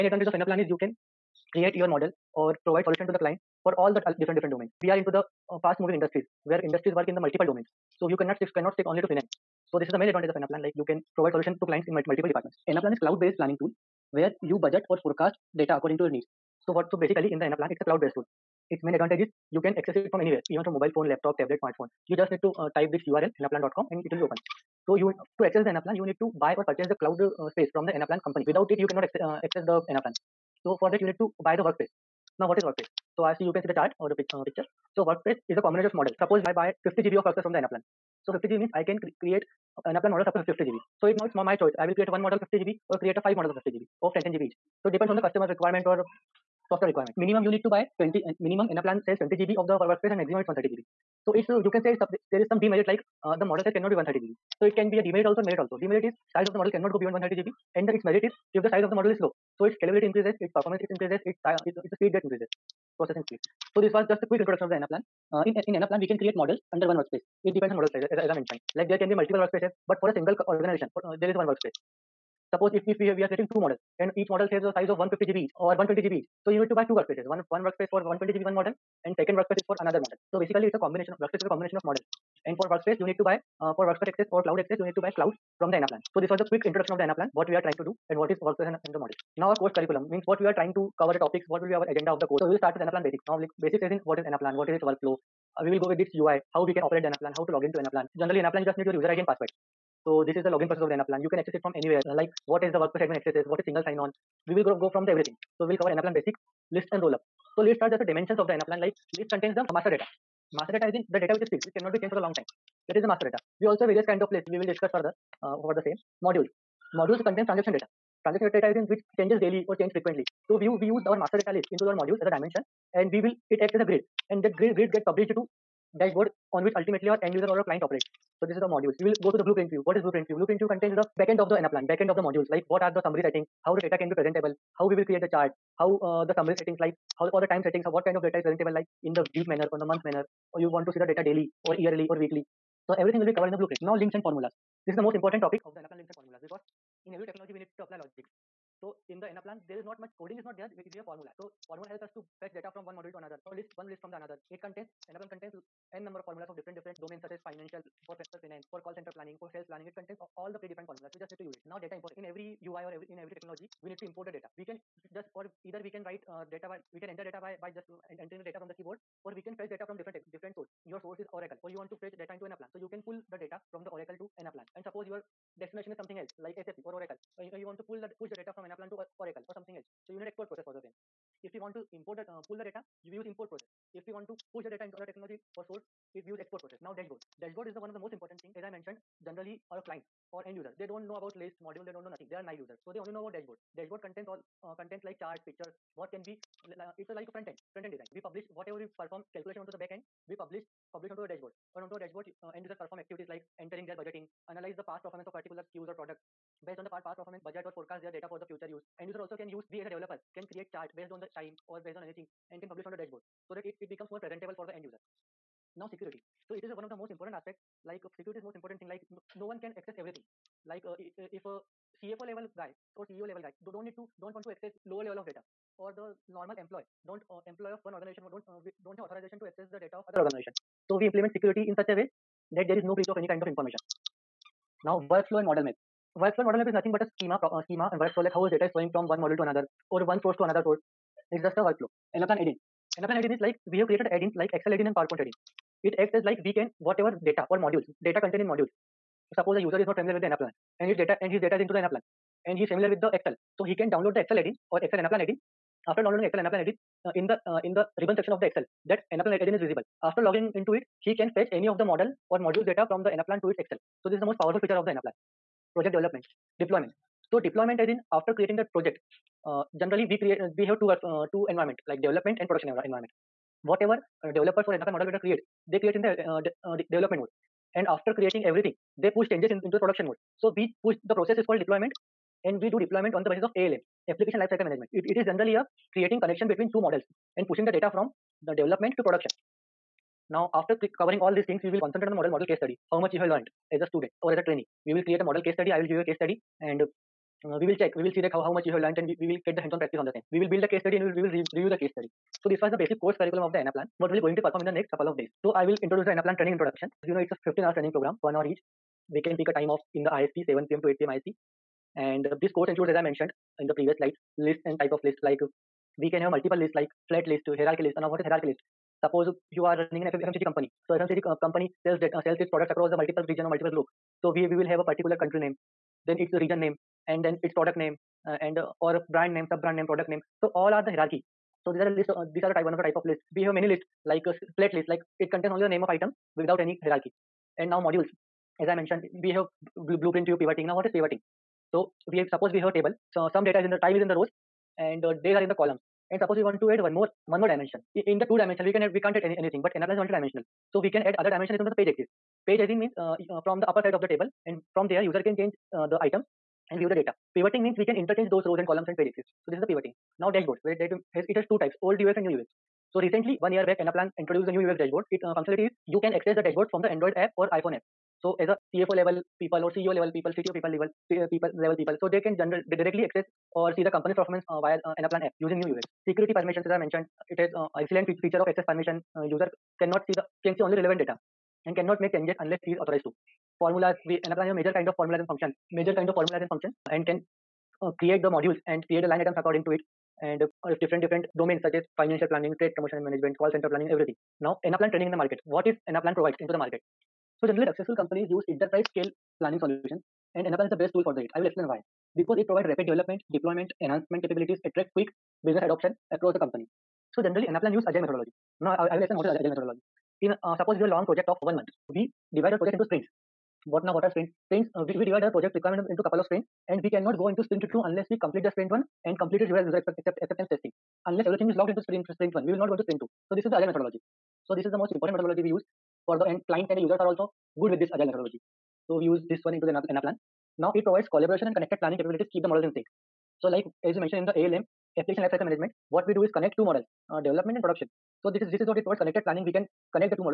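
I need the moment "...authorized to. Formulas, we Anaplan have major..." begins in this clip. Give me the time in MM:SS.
06:22.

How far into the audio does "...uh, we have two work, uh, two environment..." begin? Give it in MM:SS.
04:30.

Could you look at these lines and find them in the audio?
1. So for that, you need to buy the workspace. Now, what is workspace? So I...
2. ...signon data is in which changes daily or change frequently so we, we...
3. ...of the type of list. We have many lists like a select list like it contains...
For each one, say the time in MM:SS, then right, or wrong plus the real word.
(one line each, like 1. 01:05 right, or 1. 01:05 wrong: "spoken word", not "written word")
1. 00:30 right
2. 01:58 wrong: "transaction", not "signon"
3. 05:32 right.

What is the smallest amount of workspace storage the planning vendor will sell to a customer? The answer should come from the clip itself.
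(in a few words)
20 GB.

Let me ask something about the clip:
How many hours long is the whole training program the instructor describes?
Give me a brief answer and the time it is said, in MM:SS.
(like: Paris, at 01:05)
15, at 05:07.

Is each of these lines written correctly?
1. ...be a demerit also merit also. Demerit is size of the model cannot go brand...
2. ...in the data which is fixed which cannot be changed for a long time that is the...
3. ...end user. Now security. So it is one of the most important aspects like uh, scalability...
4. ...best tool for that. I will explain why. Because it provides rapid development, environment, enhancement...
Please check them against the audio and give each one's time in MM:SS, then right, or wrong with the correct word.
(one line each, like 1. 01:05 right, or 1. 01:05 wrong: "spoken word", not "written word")
1. 00:54 wrong: "beyond", not "brand"
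2. 01:50 right
3. 03:34 wrong: "security", not "scalability"
4. 06:40 wrong: "deployment", not "environment".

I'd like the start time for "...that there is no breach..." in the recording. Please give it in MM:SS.
03:52.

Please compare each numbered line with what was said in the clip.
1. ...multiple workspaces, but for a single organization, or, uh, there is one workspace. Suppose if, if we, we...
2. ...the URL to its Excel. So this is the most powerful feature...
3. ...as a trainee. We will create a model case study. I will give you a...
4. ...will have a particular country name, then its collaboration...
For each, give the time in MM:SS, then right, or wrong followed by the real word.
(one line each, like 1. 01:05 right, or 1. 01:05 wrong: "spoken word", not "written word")
1. 01:09 right
2. 04:23 wrong: "Anaplan", not "URL"
3. 04:54 right
4. 05:24 wrong: "region", not "collaboration".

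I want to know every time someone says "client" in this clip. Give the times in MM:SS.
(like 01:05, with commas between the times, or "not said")
00:03, 00:11, 02:07, 03:09, 07:06.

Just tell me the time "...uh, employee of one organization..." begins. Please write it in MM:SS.
03:47.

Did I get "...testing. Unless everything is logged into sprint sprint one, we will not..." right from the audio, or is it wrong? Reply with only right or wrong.
right.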